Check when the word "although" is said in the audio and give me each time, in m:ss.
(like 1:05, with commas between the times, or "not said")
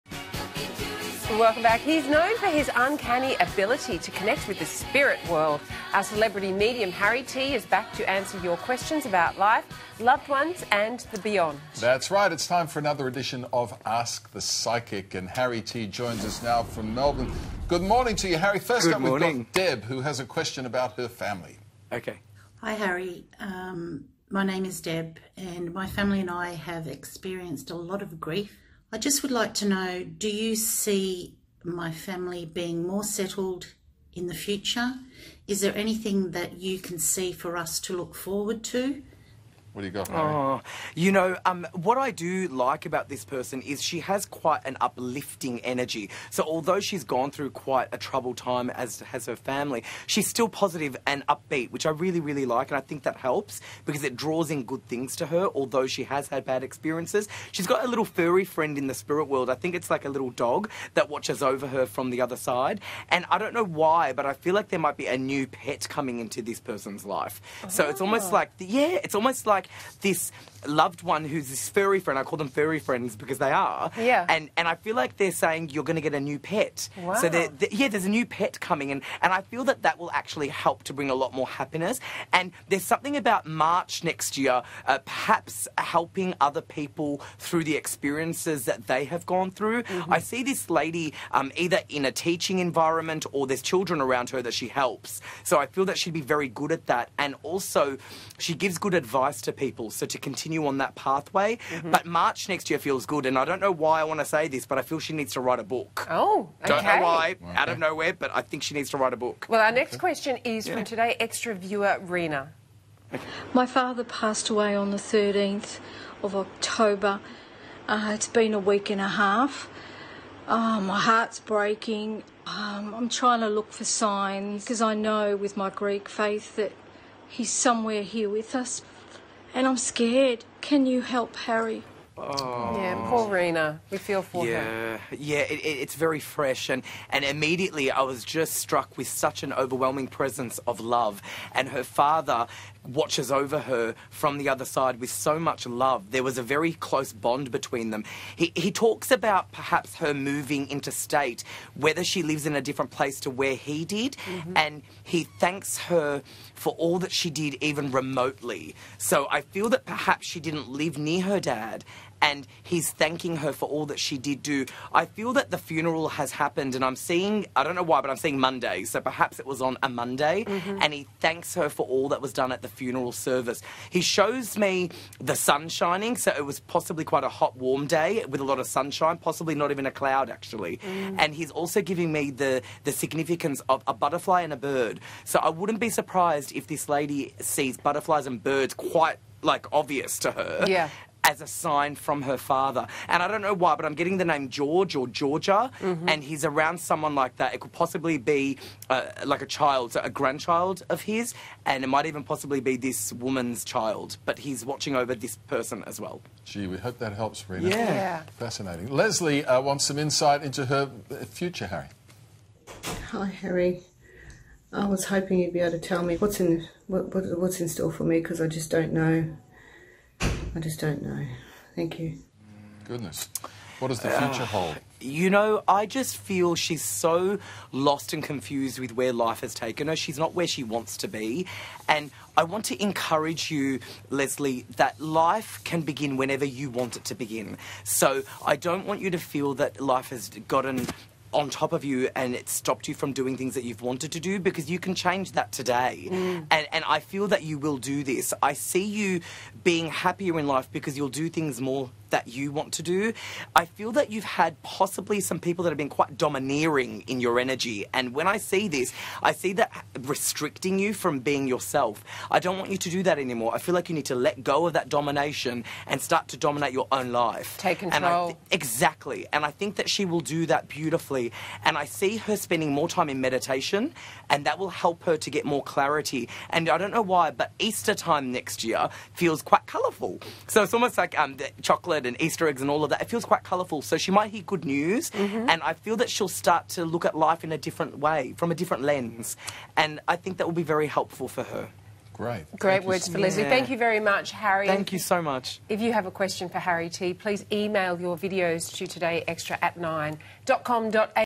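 0:46, 0:55.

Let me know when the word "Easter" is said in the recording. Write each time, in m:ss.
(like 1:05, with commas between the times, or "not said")
4:37, 4:42.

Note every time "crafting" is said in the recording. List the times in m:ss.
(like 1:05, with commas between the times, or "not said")
not said.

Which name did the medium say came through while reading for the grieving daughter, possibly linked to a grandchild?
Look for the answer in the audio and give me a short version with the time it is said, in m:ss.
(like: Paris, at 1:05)
George or Georgia, at 3:14.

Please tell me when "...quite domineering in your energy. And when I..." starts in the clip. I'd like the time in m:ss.
4:15.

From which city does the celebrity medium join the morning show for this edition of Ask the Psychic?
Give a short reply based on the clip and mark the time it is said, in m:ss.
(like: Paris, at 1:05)
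Melbourne, at 0:16.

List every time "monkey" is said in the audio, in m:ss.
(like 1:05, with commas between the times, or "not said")
not said.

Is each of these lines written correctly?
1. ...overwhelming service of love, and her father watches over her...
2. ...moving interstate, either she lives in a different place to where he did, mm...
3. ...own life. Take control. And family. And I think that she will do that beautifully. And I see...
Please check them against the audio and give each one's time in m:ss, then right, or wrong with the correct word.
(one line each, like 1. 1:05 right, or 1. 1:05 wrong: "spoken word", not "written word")
1. 2:19 wrong: "presence", not "service"
2. 2:30 wrong: "whether", not "either"
3. 4:26 wrong: "exactly", not "family".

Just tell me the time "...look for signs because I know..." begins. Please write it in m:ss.
2:03.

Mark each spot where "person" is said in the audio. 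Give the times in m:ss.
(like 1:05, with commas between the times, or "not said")
0:43, 1:06, 3:25.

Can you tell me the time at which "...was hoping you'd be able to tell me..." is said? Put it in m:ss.
3:34.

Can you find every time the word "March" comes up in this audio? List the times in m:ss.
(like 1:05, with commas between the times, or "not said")
1:23, 1:42.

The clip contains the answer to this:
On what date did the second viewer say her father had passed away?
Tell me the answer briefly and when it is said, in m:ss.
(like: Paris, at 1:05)
13th of October, at 1:54.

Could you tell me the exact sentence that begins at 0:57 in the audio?
She's got a little furry friend in the spirit world.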